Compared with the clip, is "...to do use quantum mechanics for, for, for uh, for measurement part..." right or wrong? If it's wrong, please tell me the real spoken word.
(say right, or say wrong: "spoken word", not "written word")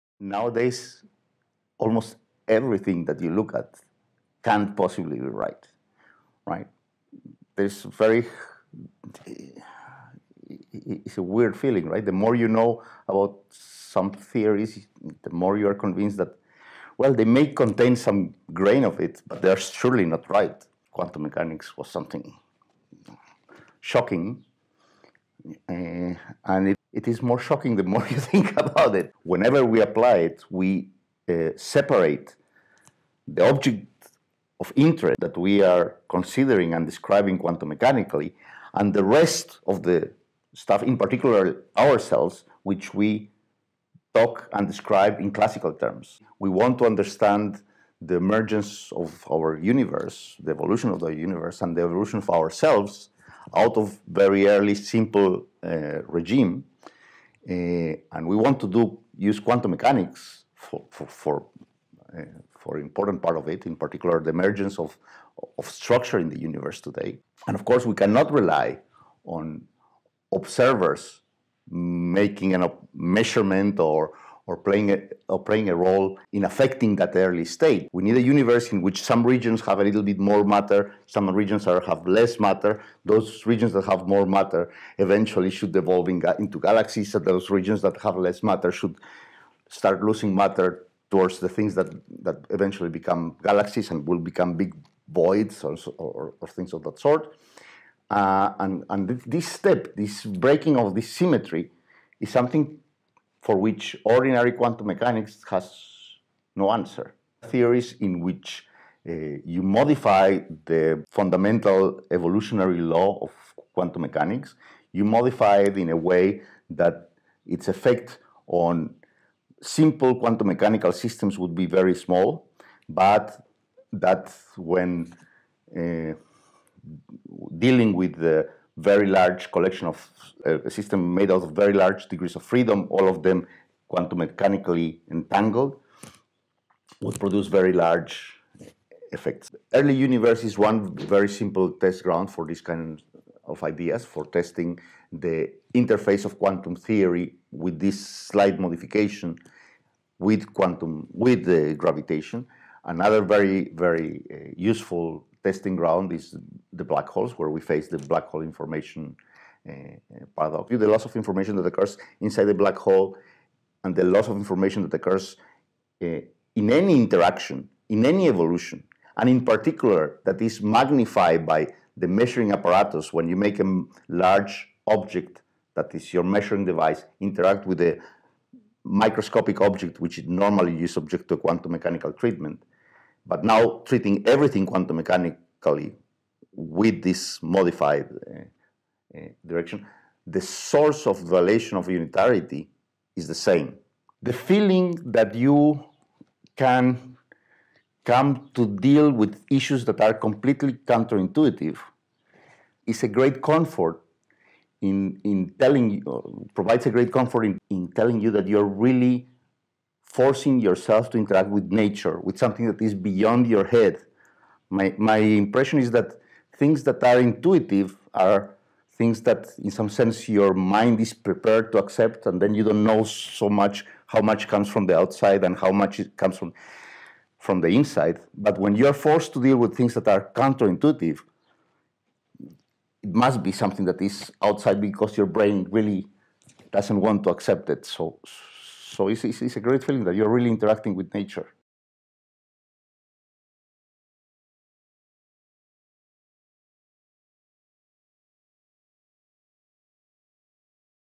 wrong: "important", not "measurement".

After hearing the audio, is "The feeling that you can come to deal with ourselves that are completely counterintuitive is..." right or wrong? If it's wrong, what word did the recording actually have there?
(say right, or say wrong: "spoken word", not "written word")
wrong: "issues", not "ourselves".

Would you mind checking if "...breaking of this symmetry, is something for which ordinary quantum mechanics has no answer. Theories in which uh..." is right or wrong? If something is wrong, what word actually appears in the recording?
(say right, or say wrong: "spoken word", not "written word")
right.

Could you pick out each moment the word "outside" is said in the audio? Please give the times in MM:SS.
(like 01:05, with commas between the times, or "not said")
03:44, 03:54.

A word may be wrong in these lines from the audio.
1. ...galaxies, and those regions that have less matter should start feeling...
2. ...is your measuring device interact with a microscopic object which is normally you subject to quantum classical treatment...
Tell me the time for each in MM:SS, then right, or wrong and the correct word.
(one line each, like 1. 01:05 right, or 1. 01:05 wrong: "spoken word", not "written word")
1. 01:26 wrong: "losing", not "feeling"
2. 02:55 wrong: "mechanical", not "classical".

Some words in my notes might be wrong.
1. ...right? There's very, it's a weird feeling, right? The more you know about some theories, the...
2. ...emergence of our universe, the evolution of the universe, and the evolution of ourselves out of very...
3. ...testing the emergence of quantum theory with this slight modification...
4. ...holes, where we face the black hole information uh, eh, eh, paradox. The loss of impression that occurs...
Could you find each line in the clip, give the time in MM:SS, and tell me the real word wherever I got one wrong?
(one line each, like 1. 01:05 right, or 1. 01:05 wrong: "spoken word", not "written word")
1. 00:06 right
2. 00:48 right
3. 02:24 wrong: "interface", not "emergence"
4. 02:37 wrong: "information", not "impression".